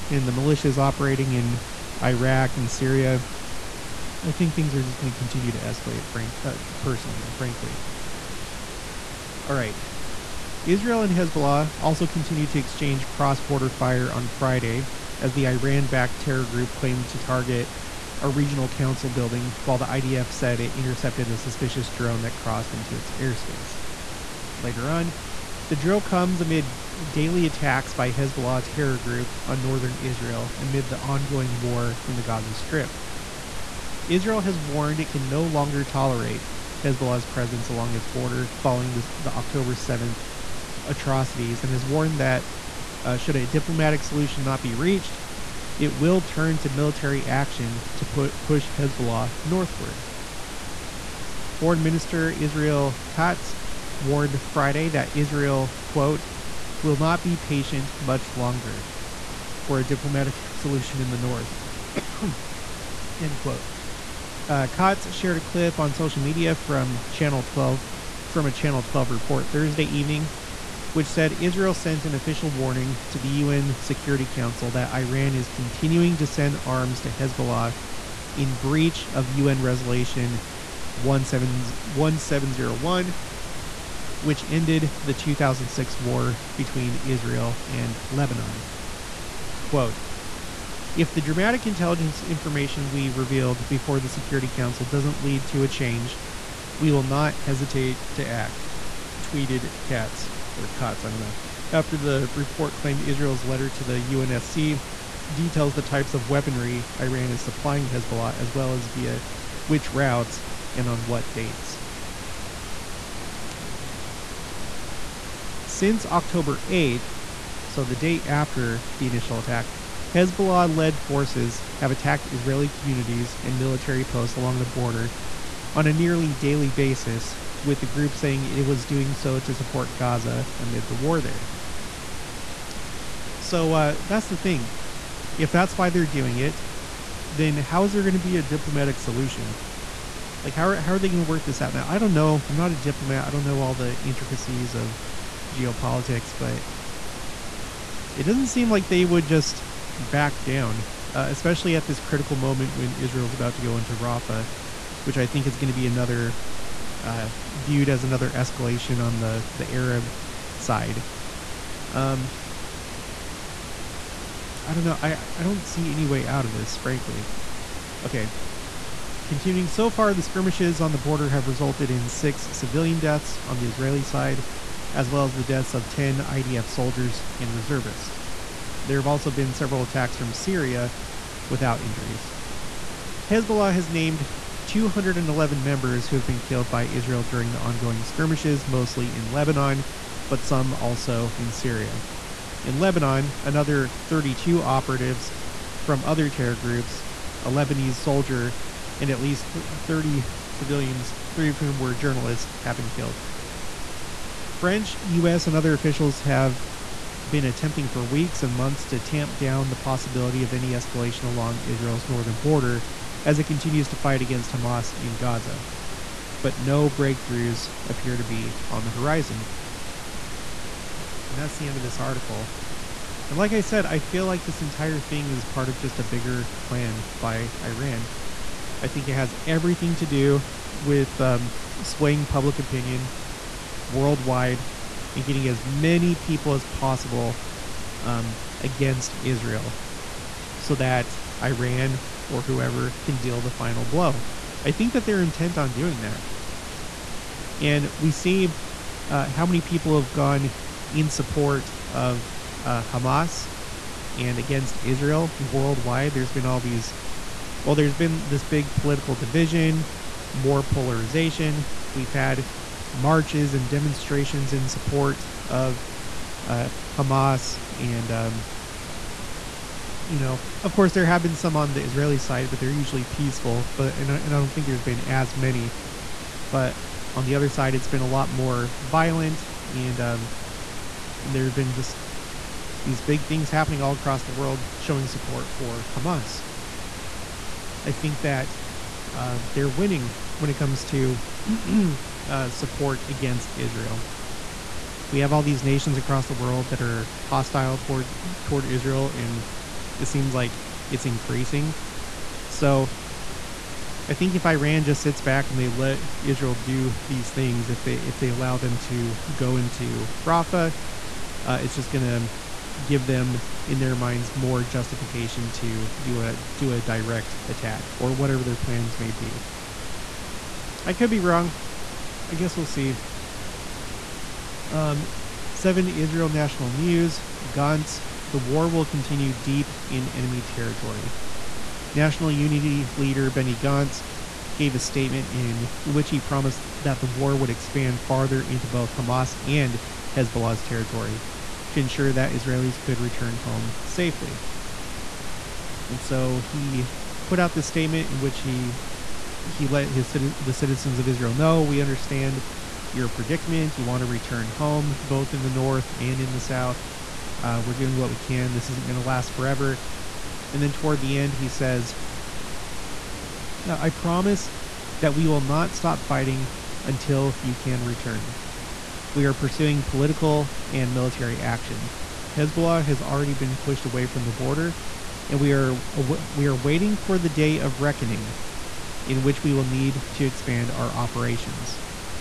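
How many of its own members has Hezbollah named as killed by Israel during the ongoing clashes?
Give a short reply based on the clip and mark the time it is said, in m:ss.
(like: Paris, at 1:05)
211, at 3:04.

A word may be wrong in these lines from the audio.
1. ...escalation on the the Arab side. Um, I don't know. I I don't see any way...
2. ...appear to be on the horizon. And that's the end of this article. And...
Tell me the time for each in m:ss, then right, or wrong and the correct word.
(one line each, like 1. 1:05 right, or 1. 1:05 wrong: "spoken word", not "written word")
1. 2:38 right
2. 3:37 right.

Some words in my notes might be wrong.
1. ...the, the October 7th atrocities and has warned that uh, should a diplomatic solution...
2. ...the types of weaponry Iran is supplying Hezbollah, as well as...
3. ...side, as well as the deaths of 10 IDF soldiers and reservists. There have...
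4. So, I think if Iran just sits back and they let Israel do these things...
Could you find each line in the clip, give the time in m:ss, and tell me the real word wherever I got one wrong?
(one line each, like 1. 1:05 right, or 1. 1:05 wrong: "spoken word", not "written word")
1. 0:38 right
2. 1:45 right
3. 2:54 right
4. 5:02 right.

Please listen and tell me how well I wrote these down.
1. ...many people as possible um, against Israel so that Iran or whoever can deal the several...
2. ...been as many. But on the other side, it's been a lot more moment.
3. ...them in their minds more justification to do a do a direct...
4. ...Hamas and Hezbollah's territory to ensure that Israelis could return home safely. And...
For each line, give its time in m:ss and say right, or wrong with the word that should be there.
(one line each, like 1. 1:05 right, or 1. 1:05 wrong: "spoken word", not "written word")
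1. 3:55 wrong: "final", not "several"
2. 4:34 wrong: "violent", not "moment"
3. 5:13 right
4. 5:38 right.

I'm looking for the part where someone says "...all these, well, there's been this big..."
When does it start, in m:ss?
4:16.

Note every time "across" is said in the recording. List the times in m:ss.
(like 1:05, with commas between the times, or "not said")
4:43, 4:55.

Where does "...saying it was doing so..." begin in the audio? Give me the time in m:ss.
2:08.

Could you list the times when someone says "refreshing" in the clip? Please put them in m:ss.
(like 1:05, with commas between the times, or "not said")
not said.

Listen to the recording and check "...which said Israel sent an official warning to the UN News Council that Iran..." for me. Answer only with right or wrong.
wrong.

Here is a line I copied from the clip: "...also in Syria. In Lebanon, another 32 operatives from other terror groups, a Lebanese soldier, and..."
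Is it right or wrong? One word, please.
right.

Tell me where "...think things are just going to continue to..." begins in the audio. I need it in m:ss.
0:04.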